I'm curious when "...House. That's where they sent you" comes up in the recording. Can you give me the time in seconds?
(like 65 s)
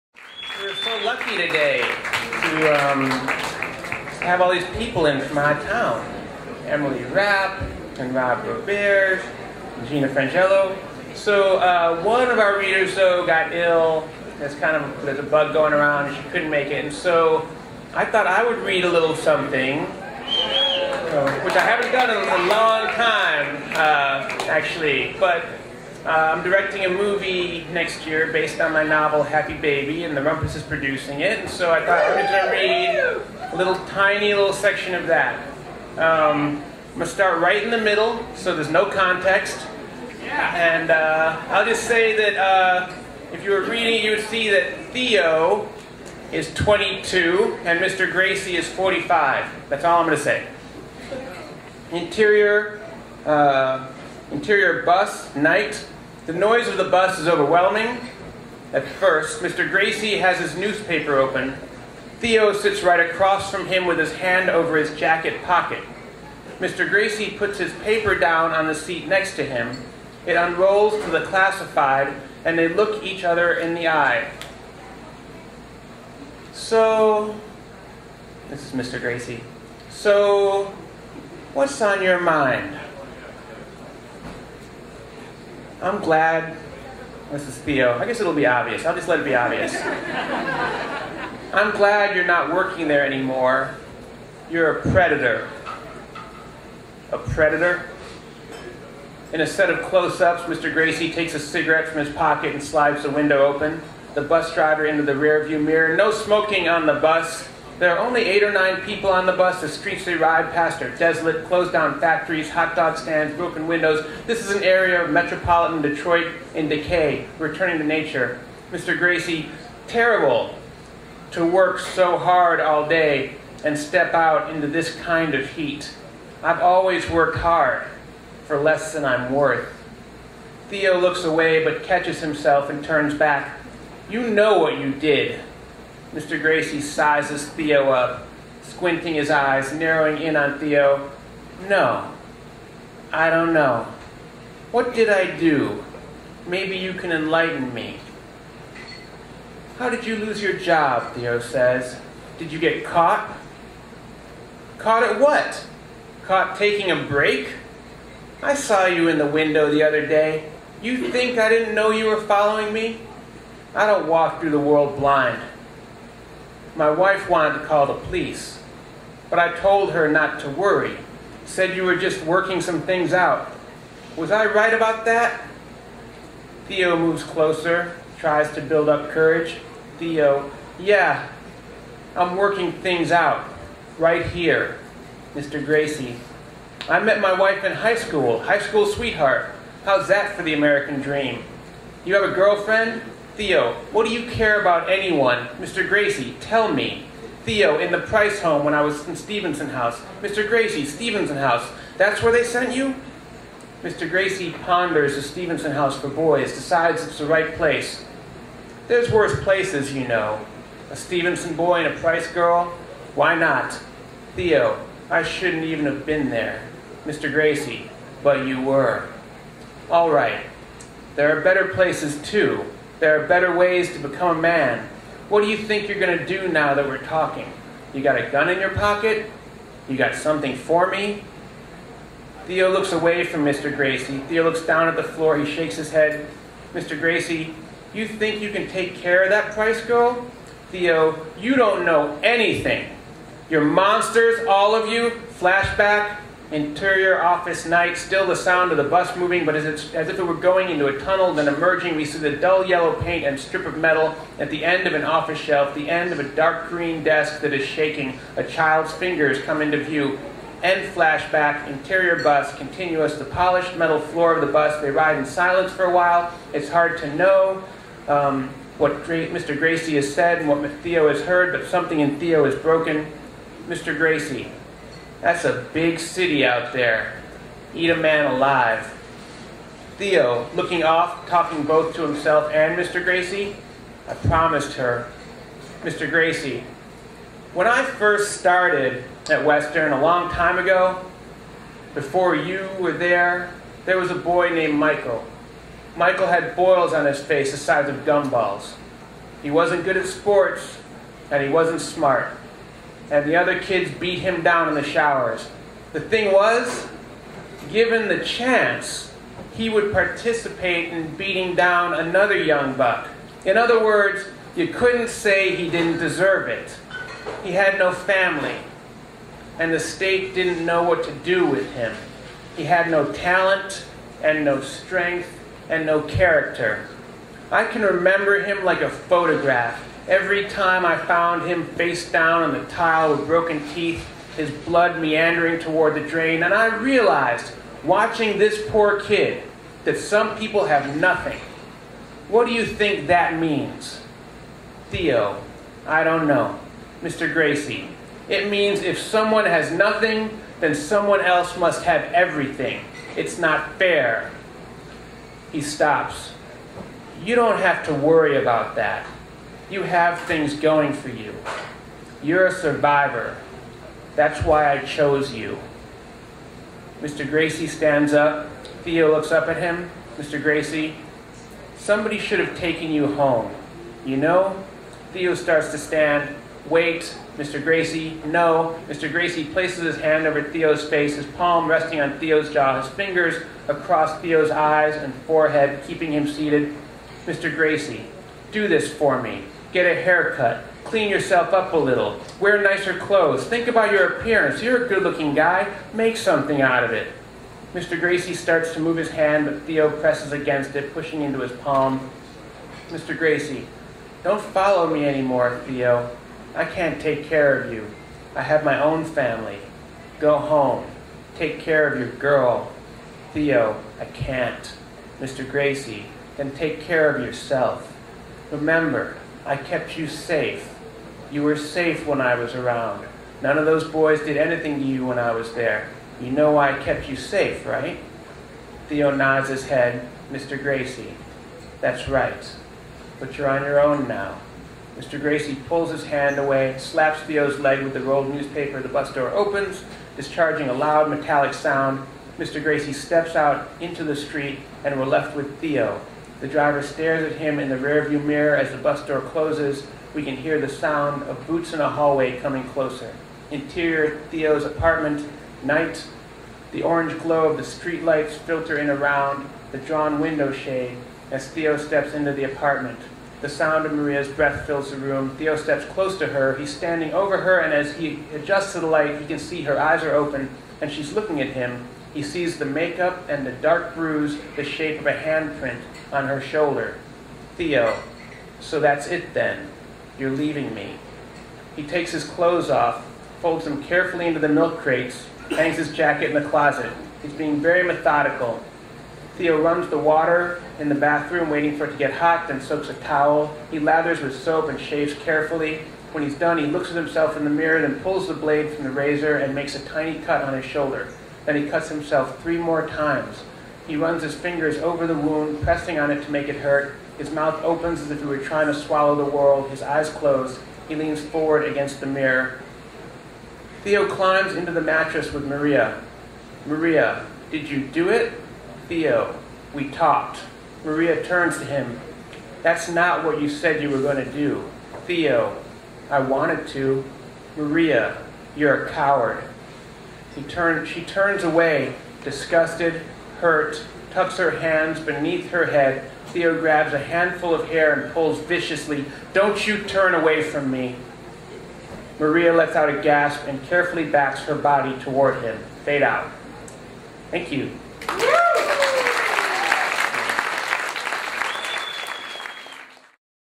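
201 s.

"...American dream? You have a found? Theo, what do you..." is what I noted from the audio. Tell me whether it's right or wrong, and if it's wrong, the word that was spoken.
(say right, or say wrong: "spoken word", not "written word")
wrong: "girlfriend", not "found".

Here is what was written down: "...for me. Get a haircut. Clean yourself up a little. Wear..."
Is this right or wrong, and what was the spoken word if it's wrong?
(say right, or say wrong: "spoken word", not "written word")
right.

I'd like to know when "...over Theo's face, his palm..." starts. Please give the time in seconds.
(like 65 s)
380 s.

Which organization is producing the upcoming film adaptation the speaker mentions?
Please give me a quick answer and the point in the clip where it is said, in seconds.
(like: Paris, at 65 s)
The Rumpus, at 30 s.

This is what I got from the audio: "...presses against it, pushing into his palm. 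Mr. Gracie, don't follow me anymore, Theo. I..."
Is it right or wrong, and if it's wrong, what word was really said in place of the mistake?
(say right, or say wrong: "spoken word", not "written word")
right.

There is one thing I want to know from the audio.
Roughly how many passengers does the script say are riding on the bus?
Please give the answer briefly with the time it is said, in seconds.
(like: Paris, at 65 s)
8 or 9, at 108 s.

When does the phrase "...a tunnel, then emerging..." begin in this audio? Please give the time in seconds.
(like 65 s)
250 s.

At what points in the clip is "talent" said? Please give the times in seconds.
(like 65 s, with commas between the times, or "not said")
323 s.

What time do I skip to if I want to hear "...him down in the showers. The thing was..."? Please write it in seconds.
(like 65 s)
304 s.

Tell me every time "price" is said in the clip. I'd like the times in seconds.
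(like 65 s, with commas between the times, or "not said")
197 s, 211 s, 239 s.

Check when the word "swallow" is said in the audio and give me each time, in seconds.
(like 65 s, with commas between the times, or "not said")
508 s.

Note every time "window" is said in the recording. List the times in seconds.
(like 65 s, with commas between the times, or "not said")
103 s, 113 s, 159 s, 460 s.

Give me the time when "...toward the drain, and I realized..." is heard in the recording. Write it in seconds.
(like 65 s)
335 s.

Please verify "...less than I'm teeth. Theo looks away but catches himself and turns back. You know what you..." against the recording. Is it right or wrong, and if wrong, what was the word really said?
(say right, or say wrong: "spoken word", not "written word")
wrong: "worth", not "teeth".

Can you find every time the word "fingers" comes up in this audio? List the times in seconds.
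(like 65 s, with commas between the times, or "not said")
258 s, 382 s, 504 s.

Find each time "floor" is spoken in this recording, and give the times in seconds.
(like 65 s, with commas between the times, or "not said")
235 s, 264 s.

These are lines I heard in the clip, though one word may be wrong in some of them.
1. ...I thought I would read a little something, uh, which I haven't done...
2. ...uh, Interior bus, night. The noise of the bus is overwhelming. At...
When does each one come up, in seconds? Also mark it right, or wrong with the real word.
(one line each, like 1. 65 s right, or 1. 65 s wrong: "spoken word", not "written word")
1. 17 s right
2. 53 s right.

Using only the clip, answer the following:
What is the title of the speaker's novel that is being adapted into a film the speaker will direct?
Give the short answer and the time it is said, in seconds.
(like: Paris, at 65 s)
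Happy Baby, at 29 s.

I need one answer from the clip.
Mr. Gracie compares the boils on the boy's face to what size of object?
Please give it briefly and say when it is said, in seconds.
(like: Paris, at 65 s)
gumballs, at 298 s.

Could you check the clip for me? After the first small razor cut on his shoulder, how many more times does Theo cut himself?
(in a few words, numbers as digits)
3.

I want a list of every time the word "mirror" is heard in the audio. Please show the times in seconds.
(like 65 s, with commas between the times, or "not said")
105 s, 448 s, 497 s, 512 s.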